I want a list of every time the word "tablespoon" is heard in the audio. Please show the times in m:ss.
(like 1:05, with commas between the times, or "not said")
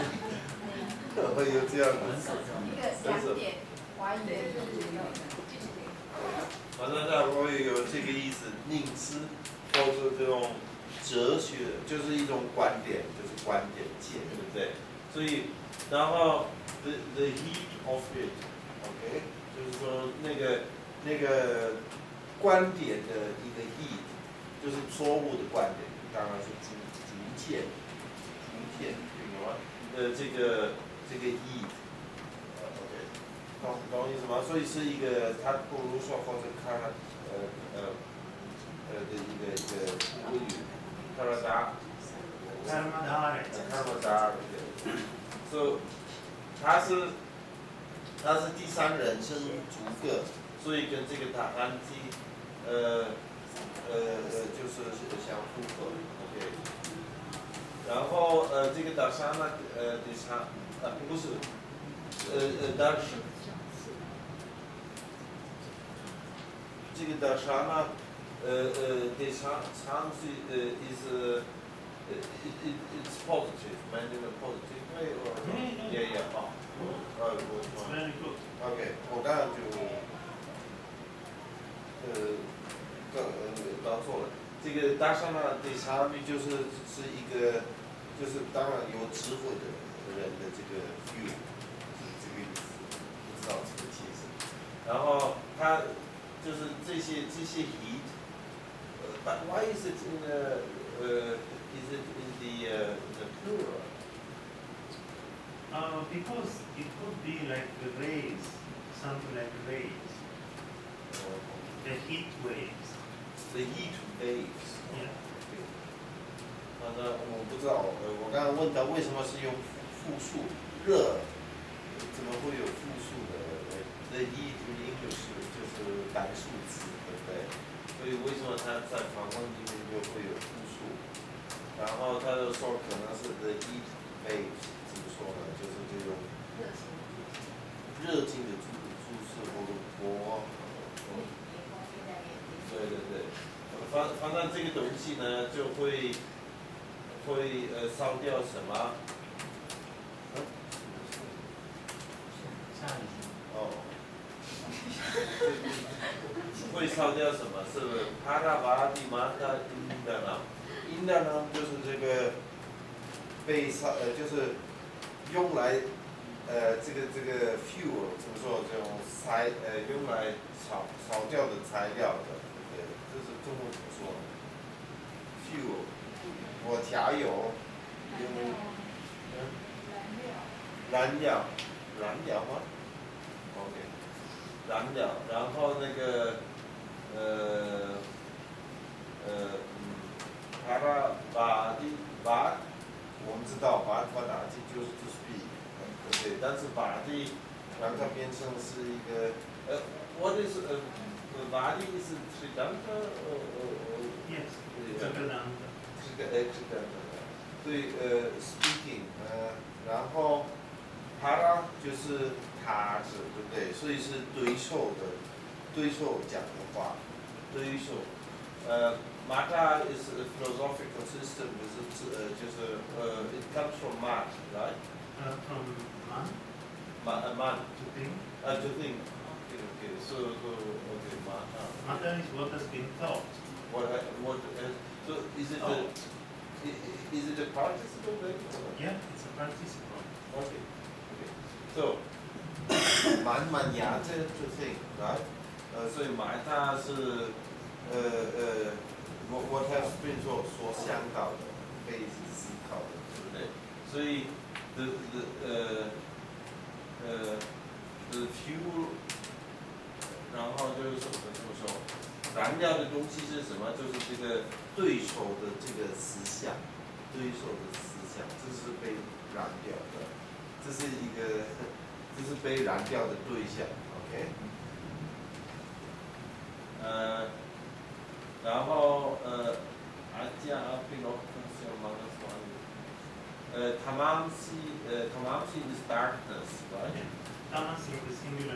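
not said.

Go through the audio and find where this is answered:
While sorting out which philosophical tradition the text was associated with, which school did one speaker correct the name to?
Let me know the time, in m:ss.
3:25.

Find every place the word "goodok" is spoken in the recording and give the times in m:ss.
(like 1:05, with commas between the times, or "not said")
1:17.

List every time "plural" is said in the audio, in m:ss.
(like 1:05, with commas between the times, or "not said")
1:43.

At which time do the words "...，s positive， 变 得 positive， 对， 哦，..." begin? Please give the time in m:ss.
1:13.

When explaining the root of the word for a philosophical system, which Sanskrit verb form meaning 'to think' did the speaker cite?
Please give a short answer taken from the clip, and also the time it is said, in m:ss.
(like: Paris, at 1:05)
manyate, at 4:03.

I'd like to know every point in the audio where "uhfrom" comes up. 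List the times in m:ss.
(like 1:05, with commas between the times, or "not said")
3:45.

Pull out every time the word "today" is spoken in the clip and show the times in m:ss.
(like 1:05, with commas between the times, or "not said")
1:54.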